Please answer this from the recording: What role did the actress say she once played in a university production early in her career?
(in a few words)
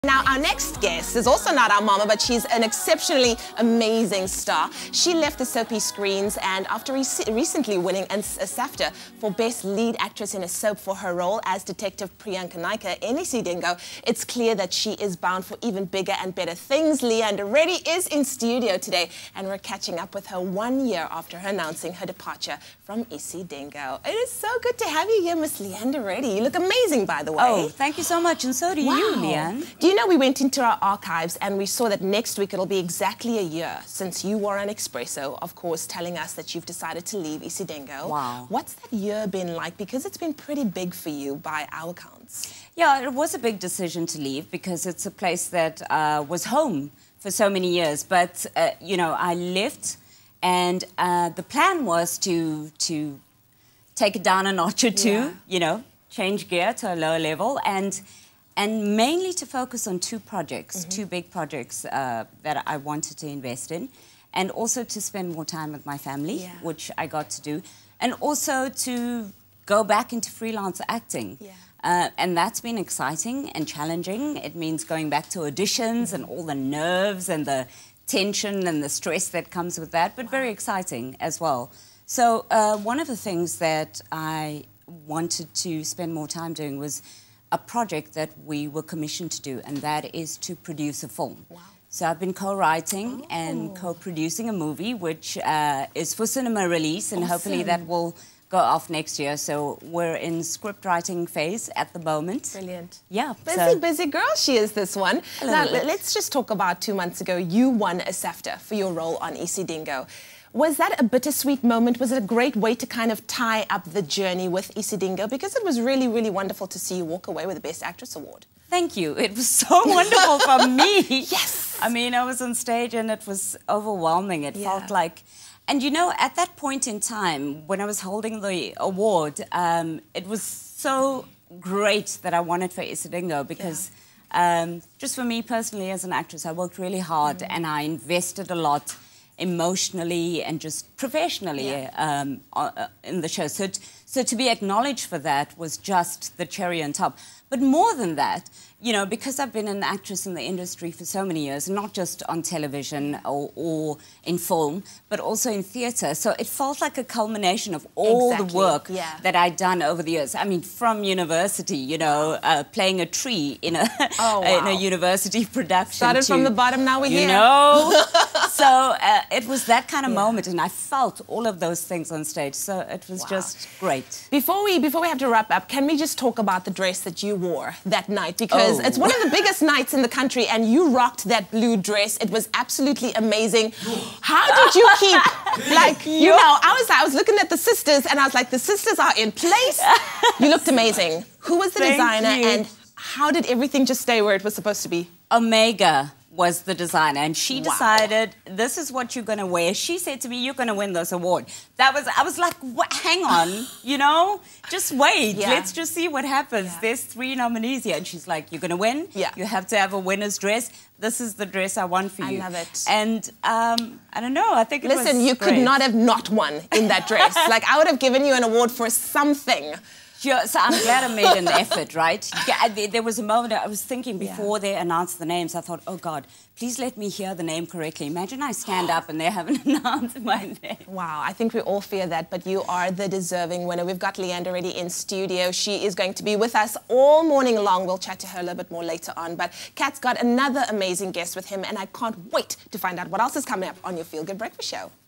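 A tree.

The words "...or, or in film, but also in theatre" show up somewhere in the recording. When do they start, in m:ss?
2:33.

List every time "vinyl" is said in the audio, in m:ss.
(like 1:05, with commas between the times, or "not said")
not said.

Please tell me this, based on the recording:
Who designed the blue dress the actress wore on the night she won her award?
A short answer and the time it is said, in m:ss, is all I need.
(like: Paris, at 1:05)
Omega, at 3:15.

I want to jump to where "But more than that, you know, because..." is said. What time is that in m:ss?
2:27.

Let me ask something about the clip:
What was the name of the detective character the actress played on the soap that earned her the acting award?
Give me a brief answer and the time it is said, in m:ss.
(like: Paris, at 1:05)
Priyanka Naicker, at 0:12.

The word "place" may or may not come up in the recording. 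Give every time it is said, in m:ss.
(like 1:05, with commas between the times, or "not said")
0:45, 3:09.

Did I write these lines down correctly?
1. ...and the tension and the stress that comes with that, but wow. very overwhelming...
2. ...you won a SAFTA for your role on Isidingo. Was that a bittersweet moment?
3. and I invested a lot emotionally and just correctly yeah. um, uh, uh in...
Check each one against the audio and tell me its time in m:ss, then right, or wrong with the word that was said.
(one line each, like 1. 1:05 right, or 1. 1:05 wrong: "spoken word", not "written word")
1. 1:17 wrong: "exciting", not "overwhelming"
2. 1:47 right
3. 2:17 wrong: "professionally", not "correctly".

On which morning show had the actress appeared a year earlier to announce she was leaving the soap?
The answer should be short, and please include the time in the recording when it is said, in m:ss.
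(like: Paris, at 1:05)
Expresso, at 0:34.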